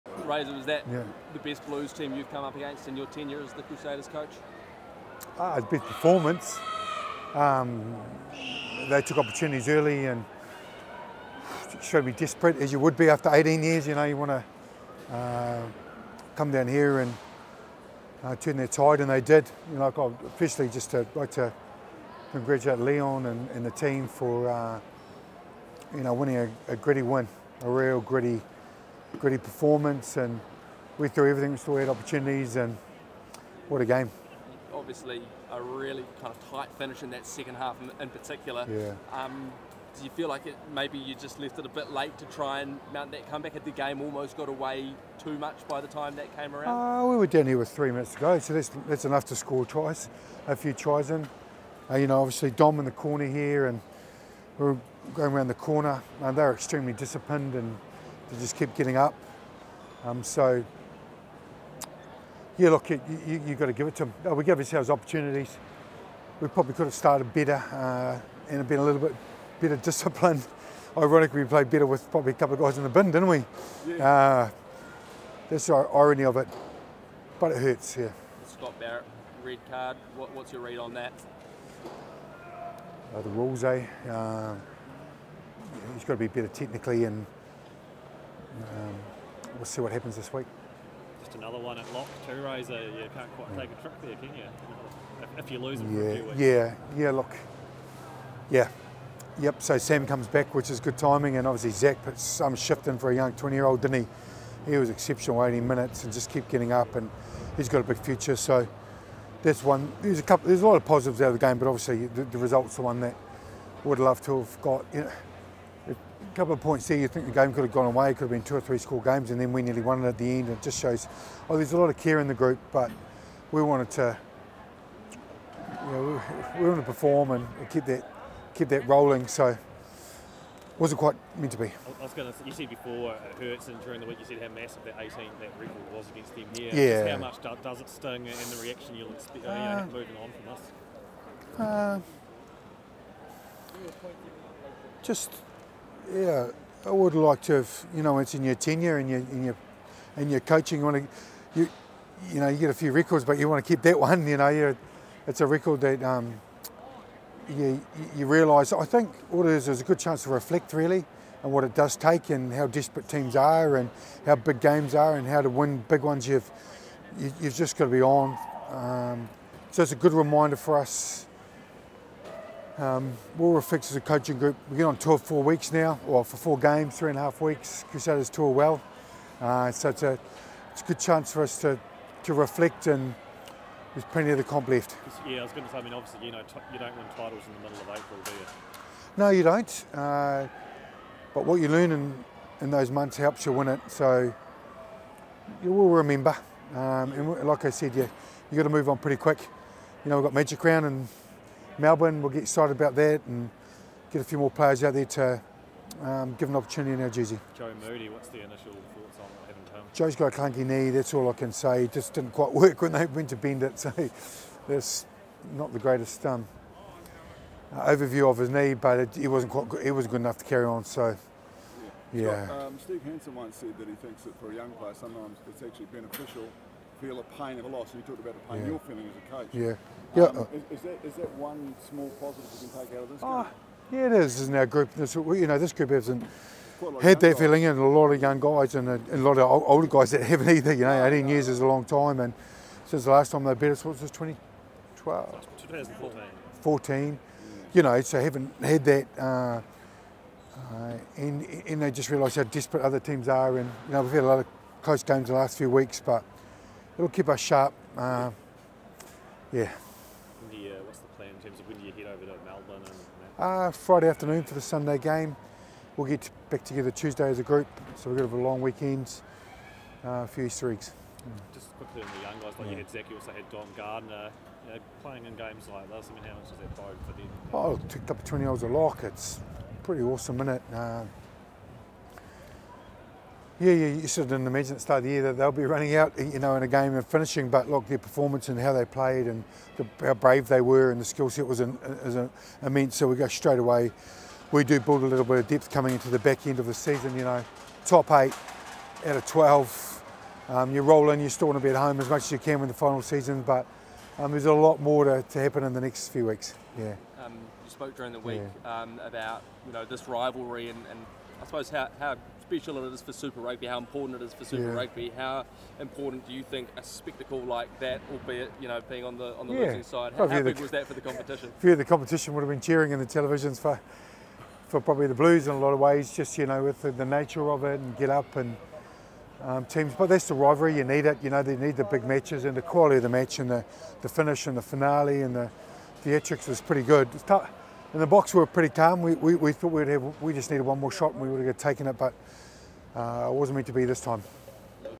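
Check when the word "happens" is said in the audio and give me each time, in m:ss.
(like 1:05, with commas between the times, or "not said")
1:29, 5:05.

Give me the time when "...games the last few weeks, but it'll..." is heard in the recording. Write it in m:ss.
4:15.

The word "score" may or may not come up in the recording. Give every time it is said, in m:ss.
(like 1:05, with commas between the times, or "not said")
0:49, 1:58.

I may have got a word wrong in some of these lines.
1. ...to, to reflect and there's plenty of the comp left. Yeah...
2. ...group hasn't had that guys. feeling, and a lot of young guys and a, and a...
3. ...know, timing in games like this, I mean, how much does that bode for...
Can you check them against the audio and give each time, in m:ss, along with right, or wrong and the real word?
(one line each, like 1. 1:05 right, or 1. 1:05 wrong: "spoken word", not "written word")
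1. 3:01 right
2. 3:55 right
3. 4:34 wrong: "playing", not "timing".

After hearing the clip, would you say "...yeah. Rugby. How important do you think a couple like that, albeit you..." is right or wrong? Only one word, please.
wrong.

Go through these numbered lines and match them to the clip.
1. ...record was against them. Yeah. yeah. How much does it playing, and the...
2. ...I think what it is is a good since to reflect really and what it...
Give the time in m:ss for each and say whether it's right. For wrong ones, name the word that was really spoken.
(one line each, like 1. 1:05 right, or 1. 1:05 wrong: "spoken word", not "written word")
1. 2:15 wrong: "sting", not "playing"
2. 2:38 wrong: "chance", not "since".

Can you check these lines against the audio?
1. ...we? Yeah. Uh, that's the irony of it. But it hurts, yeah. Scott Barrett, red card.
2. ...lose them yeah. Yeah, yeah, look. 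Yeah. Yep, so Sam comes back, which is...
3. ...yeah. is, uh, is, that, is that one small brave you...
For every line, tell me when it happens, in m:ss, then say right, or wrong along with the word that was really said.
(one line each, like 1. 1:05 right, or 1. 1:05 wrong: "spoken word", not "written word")
1. 1:13 right
2. 1:35 right
3. 3:50 wrong: "positive", not "brave".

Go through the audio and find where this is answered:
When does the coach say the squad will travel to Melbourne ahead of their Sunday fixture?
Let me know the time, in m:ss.
4:23.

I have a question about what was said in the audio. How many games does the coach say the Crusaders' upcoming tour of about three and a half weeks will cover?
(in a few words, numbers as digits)
4.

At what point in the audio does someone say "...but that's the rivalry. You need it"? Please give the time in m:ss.
5:29.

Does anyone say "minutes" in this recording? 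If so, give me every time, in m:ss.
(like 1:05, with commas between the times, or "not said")
0:47, 1:45.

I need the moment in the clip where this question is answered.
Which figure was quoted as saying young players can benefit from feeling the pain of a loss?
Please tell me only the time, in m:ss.
3:42.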